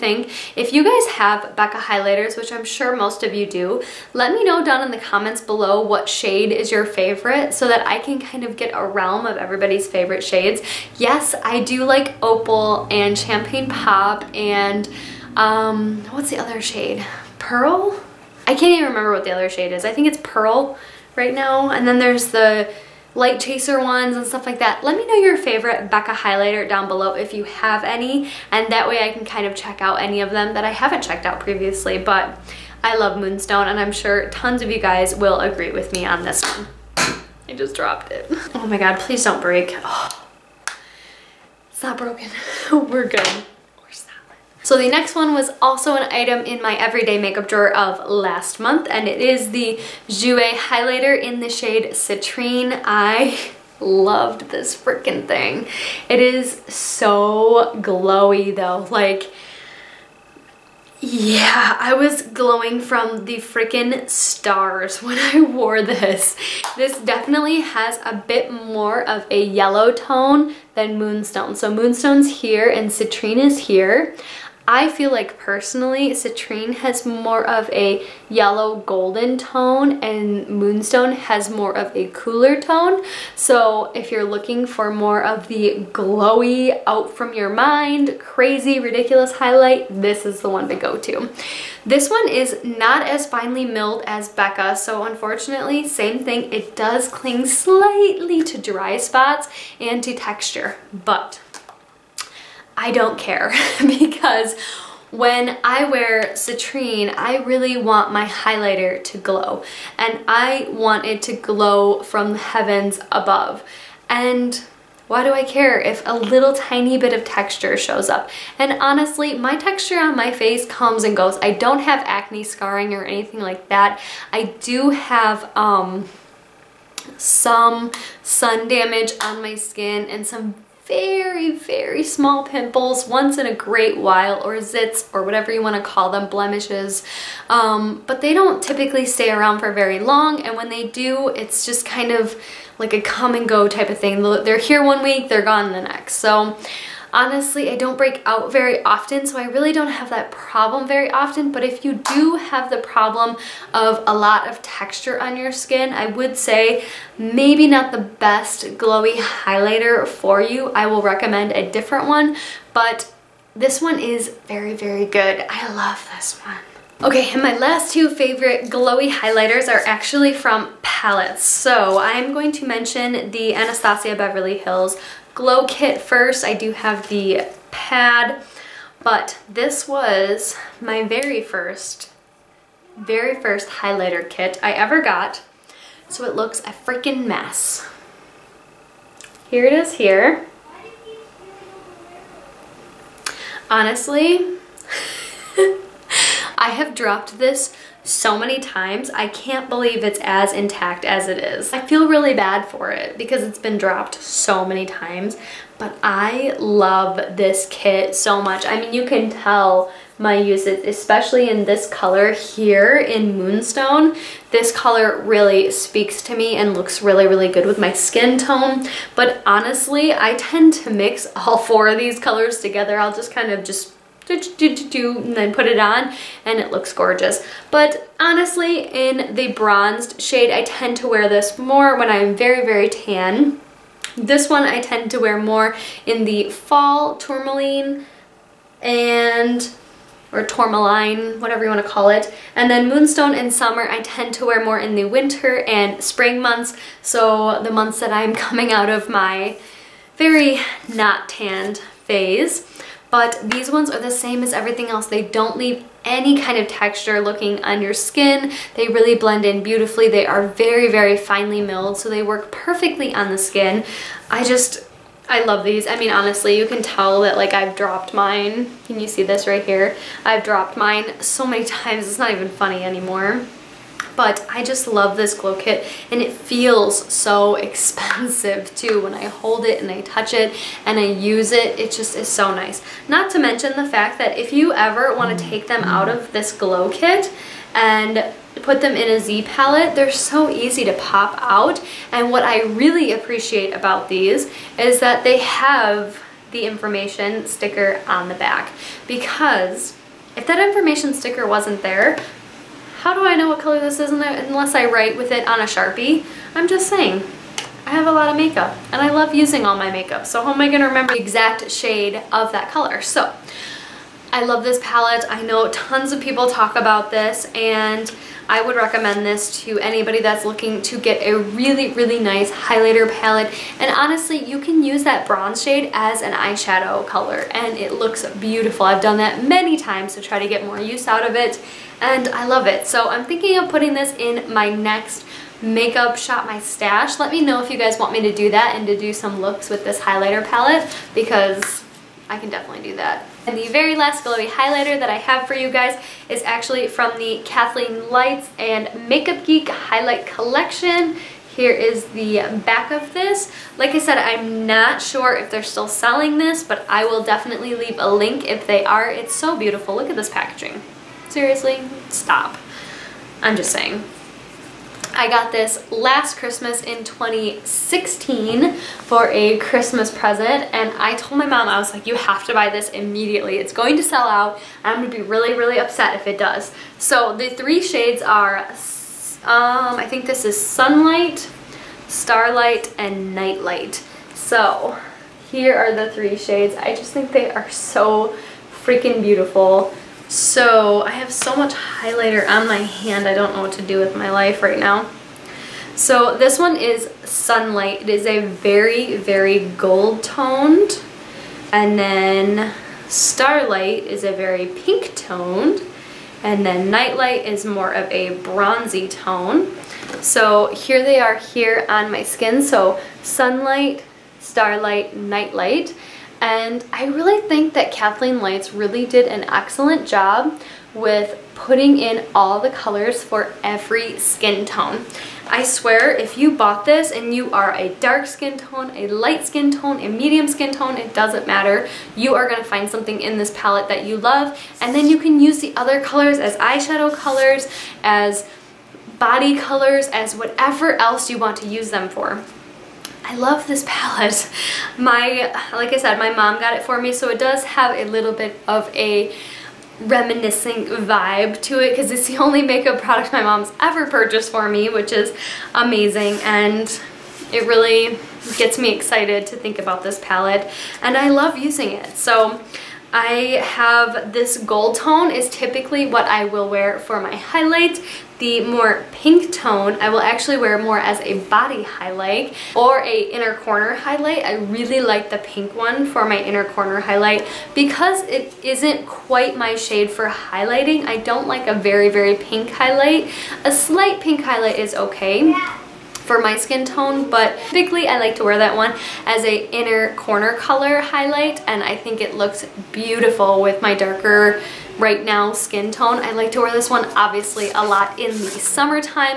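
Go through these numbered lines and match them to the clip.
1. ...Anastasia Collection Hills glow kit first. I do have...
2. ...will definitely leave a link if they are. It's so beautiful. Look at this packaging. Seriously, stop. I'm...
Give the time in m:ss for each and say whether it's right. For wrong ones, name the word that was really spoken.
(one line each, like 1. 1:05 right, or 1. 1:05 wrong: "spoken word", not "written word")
1. 2:53 wrong: "Beverly", not "Collection"
2. 5:57 right.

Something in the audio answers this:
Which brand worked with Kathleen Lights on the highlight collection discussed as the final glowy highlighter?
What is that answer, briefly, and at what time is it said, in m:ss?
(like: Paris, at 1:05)
Makeup Geek, at 5:49.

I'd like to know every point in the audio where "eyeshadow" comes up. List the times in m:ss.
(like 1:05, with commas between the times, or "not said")
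5:26, 7:16.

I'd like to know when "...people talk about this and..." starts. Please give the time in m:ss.
5:16.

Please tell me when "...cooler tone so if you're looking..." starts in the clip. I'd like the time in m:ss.
1:22.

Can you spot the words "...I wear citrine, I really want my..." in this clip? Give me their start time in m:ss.
1:45.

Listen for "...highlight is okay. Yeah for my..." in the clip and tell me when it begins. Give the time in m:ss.
8:04.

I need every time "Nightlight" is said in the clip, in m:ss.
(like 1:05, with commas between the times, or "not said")
6:23, 6:46, 6:55.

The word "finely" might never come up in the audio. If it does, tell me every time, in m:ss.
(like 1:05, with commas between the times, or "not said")
1:33, 4:21.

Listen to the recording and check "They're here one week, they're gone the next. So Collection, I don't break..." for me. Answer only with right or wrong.
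wrong.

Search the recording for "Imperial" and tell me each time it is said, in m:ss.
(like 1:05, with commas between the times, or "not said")
not said.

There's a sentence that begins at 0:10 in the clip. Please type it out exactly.
Yes, I do like opal and champagne pop and um, what's the other shade?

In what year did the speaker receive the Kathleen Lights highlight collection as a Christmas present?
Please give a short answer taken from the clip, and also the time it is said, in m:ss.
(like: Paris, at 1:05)
2016, at 6:07.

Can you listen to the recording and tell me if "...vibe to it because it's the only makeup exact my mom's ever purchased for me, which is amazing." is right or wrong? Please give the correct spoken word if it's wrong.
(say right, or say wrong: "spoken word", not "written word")
wrong: "product", not "exact".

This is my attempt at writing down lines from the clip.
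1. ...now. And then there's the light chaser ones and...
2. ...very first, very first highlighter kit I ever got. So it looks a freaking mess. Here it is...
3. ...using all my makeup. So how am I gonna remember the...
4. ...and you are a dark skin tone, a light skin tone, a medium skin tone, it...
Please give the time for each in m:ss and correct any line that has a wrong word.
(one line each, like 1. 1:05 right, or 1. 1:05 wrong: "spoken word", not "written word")
1. 0:21 right
2. 3:01 right
3. 5:09 right
4. 7:07 right.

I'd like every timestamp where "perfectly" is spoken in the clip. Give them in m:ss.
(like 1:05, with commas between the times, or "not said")
4:22.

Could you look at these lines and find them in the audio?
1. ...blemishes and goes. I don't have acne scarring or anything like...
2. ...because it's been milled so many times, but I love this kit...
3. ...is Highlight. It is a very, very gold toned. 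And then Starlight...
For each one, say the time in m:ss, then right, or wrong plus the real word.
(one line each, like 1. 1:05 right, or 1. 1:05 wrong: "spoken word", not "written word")
1. 2:00 wrong: "comes", not "blemishes"
2. 3:23 wrong: "dropped", not "milled"
3. 6:36 wrong: "Sunlight", not "Highlight".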